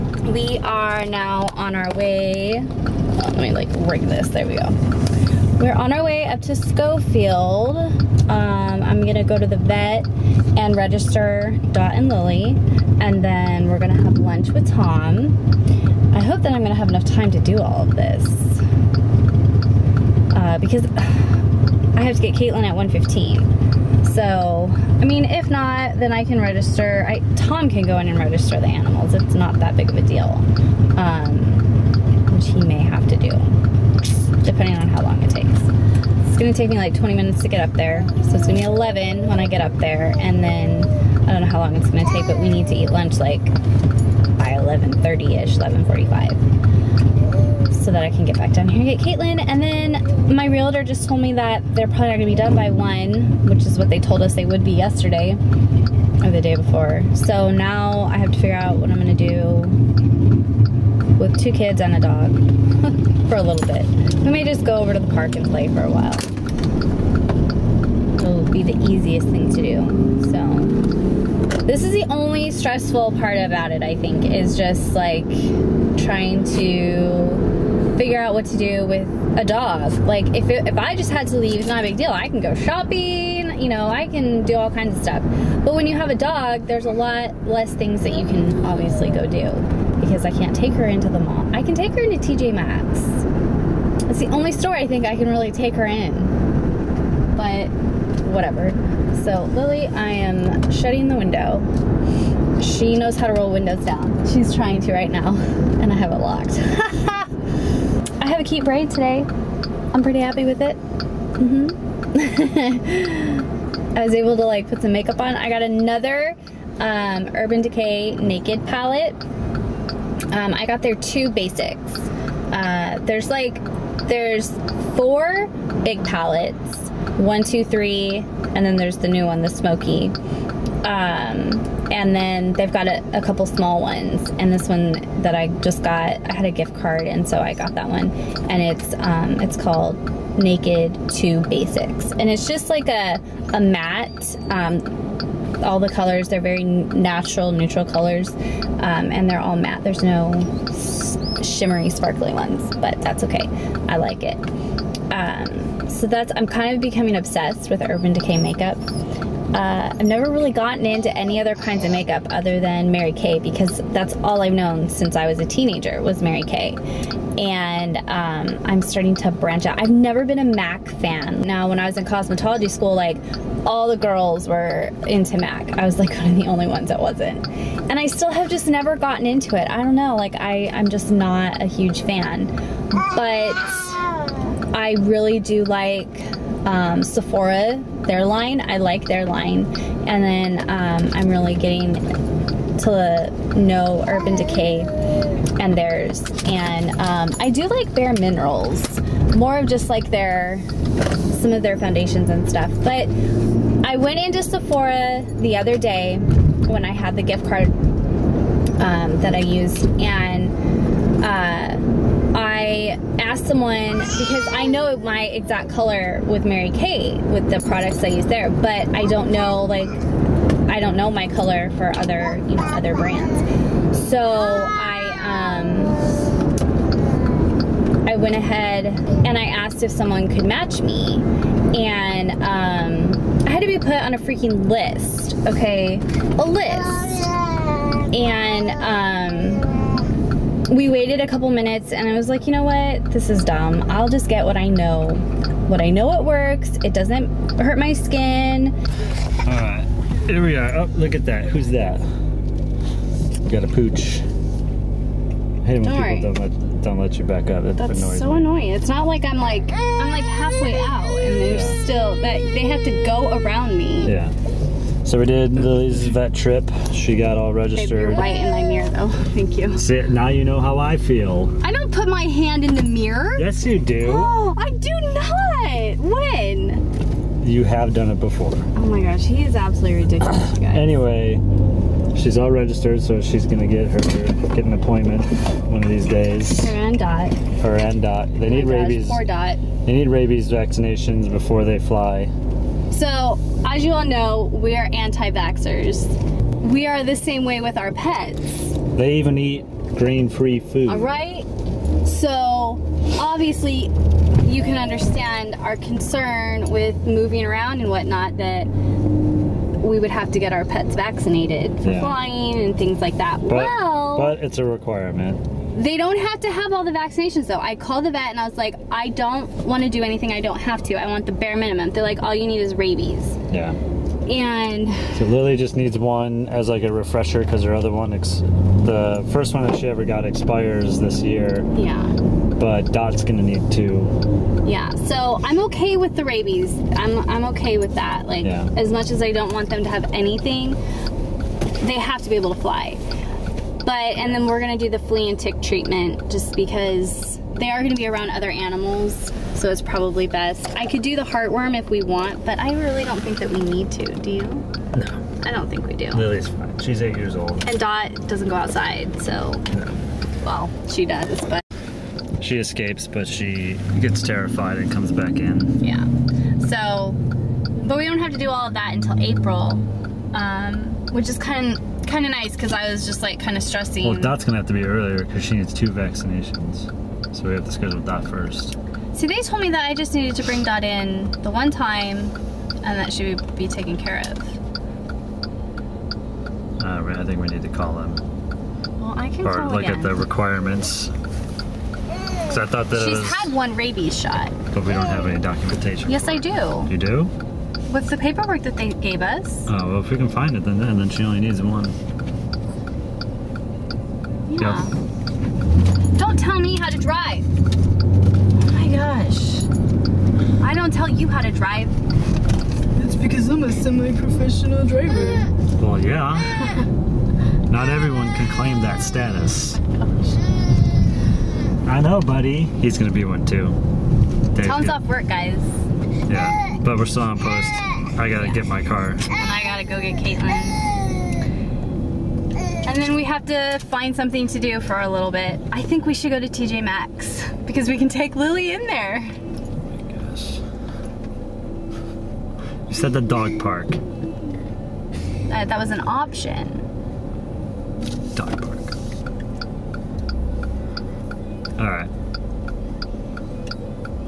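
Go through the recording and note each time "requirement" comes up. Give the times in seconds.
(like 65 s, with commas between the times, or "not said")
314 s, 390 s.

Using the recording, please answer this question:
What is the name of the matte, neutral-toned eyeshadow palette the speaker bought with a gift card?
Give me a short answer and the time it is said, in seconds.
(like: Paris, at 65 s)
Naked 2 Basics, at 140 s.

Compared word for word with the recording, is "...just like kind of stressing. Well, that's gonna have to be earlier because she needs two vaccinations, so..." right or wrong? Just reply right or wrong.
right.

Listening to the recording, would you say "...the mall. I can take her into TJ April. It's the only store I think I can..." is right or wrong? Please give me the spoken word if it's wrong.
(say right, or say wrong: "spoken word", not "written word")
wrong: "Maxx", not "April".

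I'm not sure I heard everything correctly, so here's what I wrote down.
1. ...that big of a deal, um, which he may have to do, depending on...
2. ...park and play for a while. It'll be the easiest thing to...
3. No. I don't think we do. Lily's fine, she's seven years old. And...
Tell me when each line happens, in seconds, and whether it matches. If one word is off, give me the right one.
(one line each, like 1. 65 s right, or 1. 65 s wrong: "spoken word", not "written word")
1. 29 s right
2. 65 s right
3. 354 s wrong: "eight", not "seven".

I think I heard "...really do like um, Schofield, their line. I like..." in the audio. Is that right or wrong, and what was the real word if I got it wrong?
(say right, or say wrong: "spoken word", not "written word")
wrong: "Sephora", not "Schofield".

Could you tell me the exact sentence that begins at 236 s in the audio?
A list waited a couple minutes and I was like, you know what?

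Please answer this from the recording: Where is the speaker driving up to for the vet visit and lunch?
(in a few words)
Schofield.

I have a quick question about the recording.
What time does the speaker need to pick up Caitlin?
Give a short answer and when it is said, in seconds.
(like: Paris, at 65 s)
1:15, at 22 s.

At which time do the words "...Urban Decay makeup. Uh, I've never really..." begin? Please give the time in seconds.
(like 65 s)
157 s.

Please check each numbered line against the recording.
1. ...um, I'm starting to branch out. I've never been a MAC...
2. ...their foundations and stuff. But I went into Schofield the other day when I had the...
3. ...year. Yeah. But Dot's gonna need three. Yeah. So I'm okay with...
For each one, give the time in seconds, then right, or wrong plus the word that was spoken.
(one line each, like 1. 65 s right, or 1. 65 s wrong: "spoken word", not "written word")
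1. 168 s right
2. 201 s wrong: "Sephora", not "Schofield"
3. 331 s wrong: "two", not "three".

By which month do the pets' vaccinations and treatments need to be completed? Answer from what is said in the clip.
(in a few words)
April.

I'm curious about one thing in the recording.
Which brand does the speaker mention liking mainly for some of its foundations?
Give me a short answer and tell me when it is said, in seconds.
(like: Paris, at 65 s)
Bare Minerals, at 197 s.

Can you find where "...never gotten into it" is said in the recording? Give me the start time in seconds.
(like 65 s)
178 s.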